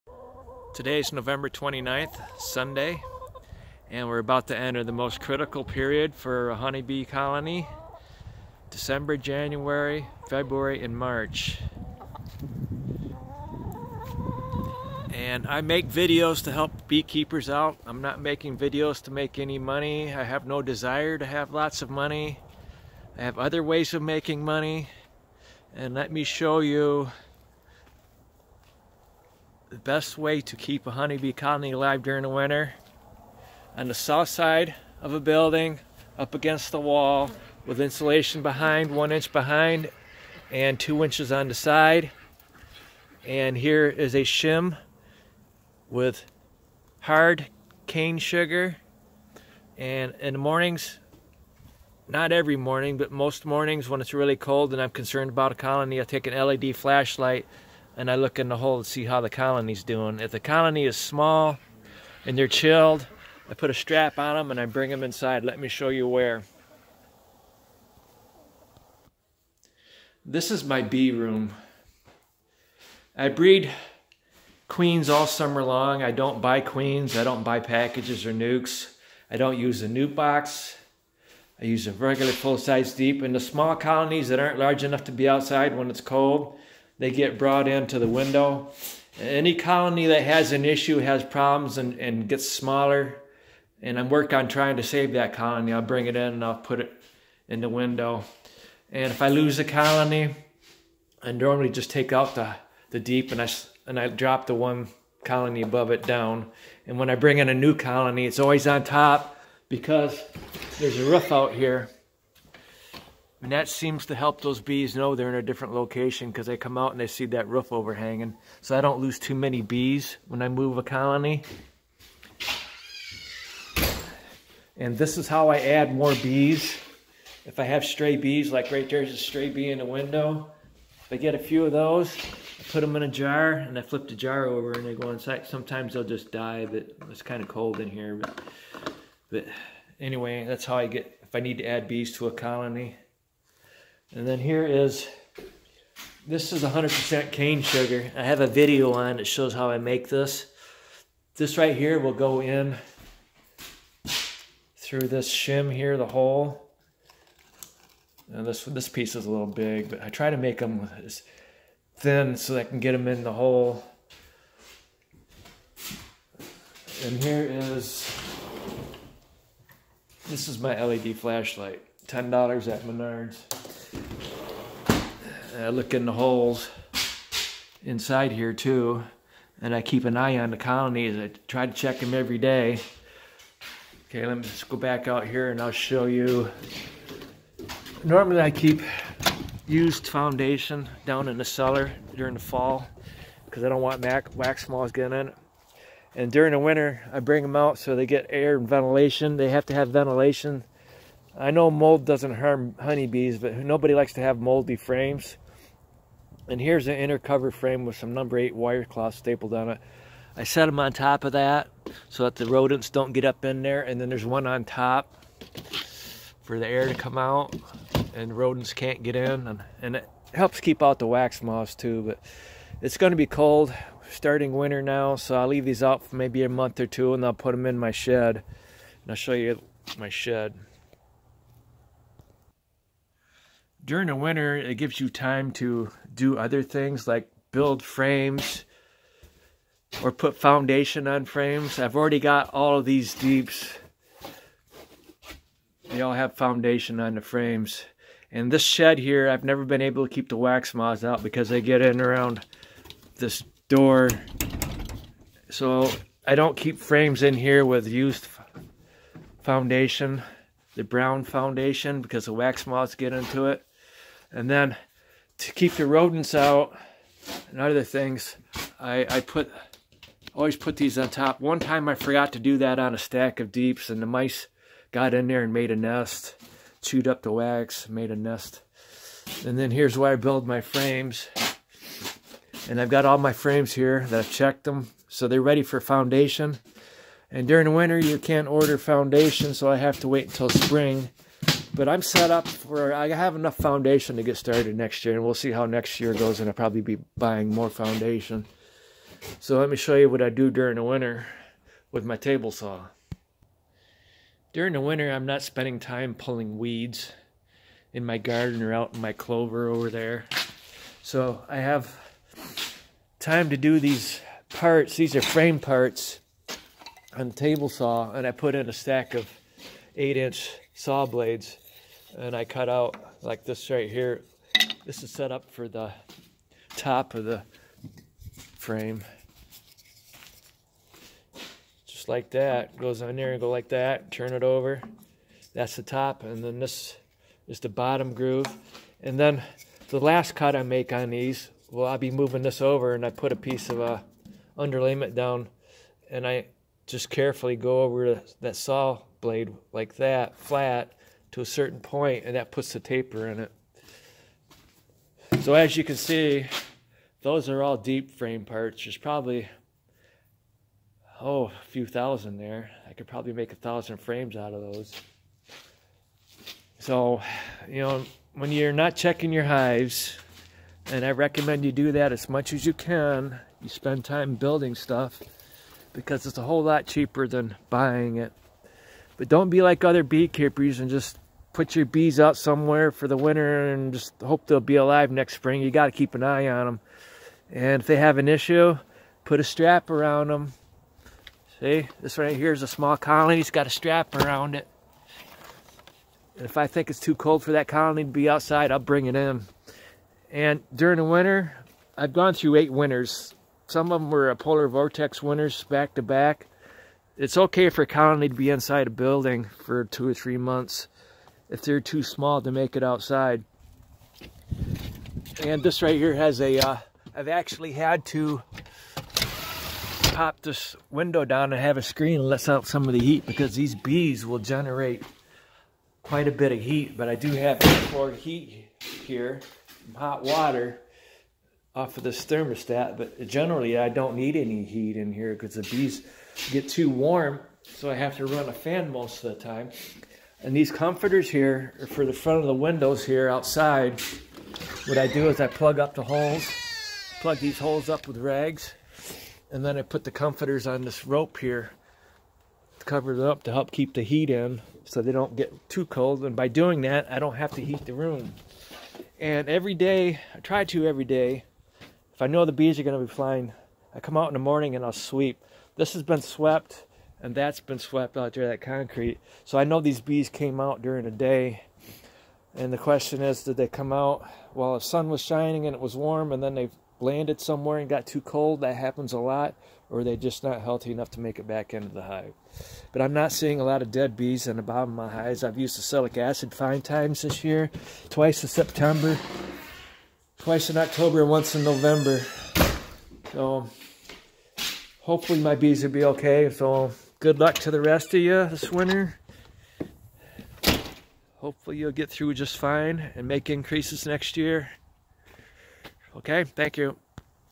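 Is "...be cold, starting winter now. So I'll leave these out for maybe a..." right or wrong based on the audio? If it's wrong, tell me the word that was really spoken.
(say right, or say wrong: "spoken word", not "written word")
right.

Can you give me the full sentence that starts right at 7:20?
And these comforters here are for the front of the windows here outside.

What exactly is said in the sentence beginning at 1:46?
And when I bring in a new colony, it's always on top because there's a roof out here.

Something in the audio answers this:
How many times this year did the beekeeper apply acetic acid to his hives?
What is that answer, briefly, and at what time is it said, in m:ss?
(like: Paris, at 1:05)
5, at 8:06.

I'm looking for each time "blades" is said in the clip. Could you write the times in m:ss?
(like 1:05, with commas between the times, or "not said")
5:21, 5:49.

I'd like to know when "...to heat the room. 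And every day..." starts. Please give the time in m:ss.
7:37.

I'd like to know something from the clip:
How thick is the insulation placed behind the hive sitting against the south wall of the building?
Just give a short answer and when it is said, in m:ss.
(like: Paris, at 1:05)
1 inch, at 0:38.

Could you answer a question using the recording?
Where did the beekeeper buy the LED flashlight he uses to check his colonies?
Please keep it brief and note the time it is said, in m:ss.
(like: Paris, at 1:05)
Menards, at 2:52.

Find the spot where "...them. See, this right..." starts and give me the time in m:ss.
6:30.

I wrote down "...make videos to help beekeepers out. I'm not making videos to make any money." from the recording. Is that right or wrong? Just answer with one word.
right.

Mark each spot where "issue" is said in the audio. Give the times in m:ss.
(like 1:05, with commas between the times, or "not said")
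1:30, 6:28.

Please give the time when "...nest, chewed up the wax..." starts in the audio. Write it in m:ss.
4:35.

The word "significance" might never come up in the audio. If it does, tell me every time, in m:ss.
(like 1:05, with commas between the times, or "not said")
not said.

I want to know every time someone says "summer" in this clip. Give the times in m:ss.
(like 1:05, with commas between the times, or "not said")
1:15.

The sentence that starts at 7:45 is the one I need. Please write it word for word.
This has been swept and that's been swept out there, that concrete.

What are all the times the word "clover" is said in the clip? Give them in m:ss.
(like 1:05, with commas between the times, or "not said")
5:09.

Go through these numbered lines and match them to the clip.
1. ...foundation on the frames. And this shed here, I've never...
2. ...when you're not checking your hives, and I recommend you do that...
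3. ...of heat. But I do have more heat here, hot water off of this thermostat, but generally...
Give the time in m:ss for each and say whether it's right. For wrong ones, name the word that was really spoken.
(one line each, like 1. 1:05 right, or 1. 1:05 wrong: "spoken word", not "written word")
1. 4:06 right
2. 6:08 right
3. 7:06 right.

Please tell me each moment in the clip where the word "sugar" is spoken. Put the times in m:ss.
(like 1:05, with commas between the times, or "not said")
0:48, 2:27.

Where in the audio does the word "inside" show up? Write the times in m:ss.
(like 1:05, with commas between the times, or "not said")
1:05, 2:15, 2:57, 6:48.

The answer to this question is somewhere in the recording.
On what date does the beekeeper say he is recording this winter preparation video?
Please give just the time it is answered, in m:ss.
0:01.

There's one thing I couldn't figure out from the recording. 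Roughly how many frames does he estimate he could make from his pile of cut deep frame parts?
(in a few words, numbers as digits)
1000.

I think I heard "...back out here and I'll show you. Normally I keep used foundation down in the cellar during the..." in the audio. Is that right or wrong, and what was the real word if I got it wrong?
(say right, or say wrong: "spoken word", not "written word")
right.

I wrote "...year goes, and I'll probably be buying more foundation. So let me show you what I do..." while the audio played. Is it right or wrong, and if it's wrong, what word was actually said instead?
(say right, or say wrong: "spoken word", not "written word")
right.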